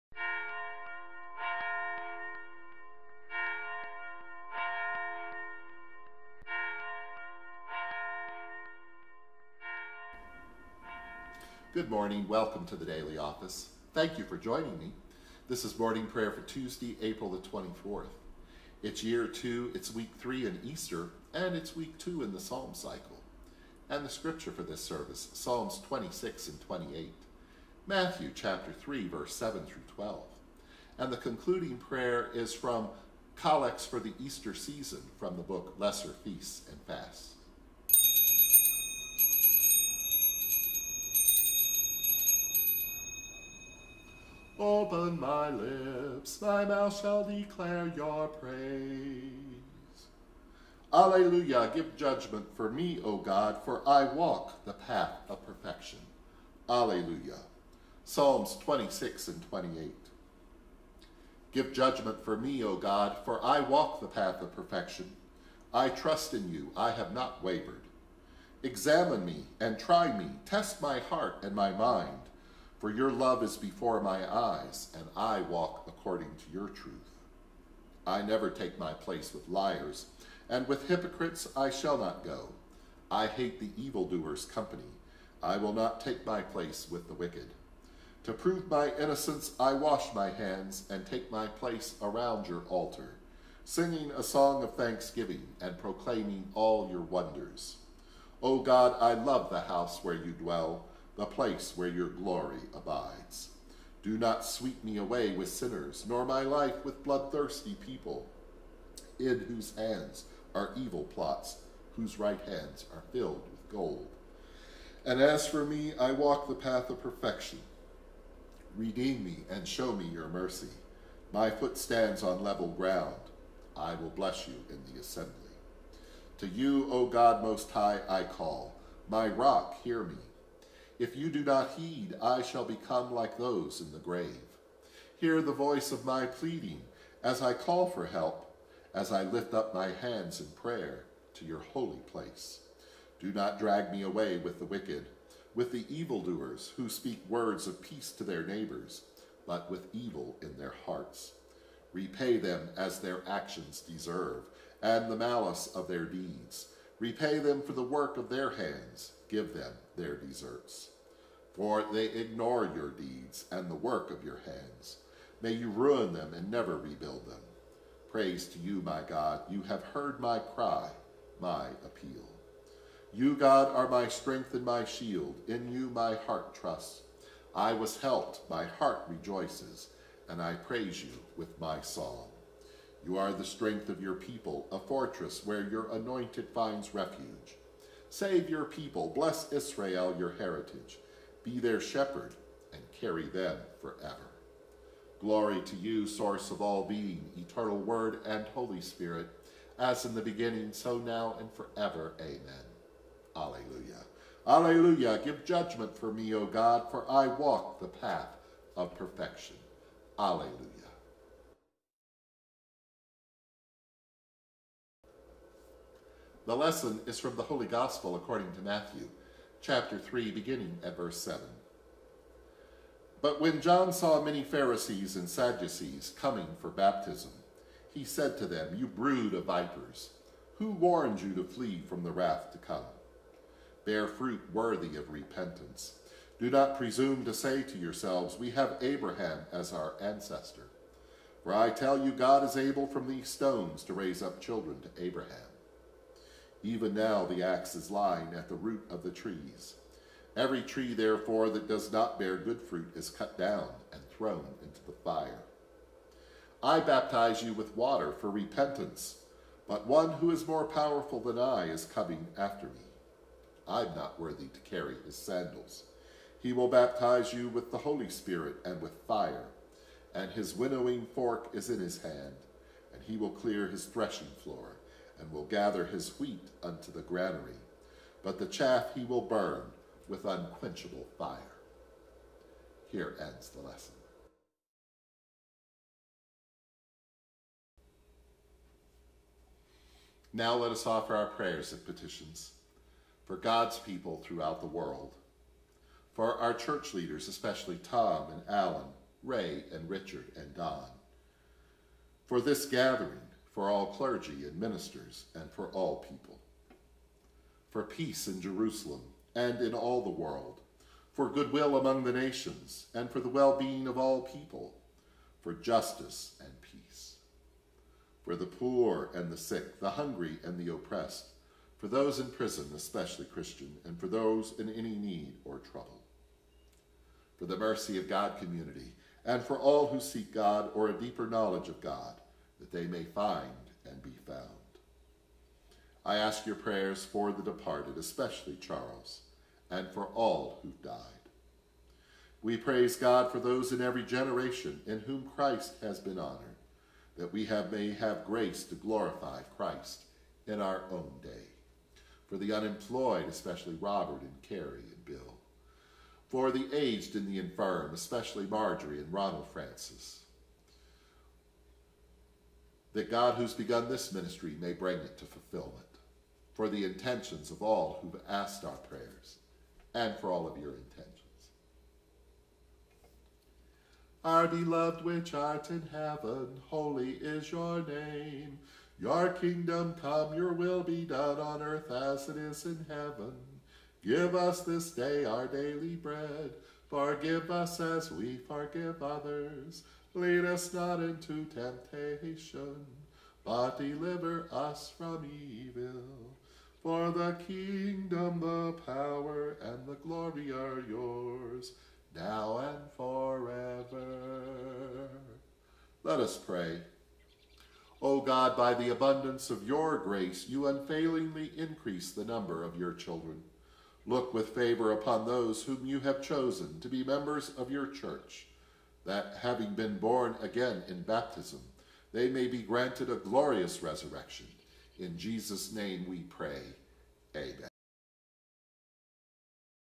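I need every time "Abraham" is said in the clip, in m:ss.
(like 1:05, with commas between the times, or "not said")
3:58, 4:05.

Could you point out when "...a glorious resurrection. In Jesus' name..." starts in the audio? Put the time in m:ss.
7:03.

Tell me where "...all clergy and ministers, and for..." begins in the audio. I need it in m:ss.
5:03.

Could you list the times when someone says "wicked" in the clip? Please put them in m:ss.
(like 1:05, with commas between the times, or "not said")
1:27, 2:24.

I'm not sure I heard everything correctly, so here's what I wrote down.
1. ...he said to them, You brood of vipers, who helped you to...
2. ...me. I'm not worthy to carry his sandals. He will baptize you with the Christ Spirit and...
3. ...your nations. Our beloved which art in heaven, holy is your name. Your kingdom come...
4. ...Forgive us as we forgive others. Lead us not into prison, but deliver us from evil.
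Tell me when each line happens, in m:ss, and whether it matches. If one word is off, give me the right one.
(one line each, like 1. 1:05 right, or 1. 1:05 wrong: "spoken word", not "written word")
1. 3:47 wrong: "warned", not "helped"
2. 4:22 wrong: "Holy", not "Christ"
3. 6:10 wrong: "intentions", not "nations"
4. 6:26 wrong: "temptation", not "prison".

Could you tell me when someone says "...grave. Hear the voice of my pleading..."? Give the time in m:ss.
2:13.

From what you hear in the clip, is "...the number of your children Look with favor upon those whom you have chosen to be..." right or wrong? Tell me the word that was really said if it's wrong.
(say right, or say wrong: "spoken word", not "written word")
right.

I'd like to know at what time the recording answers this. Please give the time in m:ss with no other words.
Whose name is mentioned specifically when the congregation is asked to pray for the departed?
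5:38.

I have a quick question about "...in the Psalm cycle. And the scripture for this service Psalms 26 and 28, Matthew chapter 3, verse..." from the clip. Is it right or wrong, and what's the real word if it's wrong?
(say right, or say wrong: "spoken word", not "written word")
right.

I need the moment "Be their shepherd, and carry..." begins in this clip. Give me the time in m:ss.
3:11.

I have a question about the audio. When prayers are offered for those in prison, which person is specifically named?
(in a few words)
Christian.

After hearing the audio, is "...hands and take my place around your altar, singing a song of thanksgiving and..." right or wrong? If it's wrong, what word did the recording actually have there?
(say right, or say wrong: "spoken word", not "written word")
right.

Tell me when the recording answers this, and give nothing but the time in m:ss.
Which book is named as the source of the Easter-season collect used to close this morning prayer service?
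0:35.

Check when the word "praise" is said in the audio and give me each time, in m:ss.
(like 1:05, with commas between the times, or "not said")
0:48, 2:48, 3:00, 5:42.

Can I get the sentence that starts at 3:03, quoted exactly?
You are the strength of your people, a fortress where your anointed finds refuge.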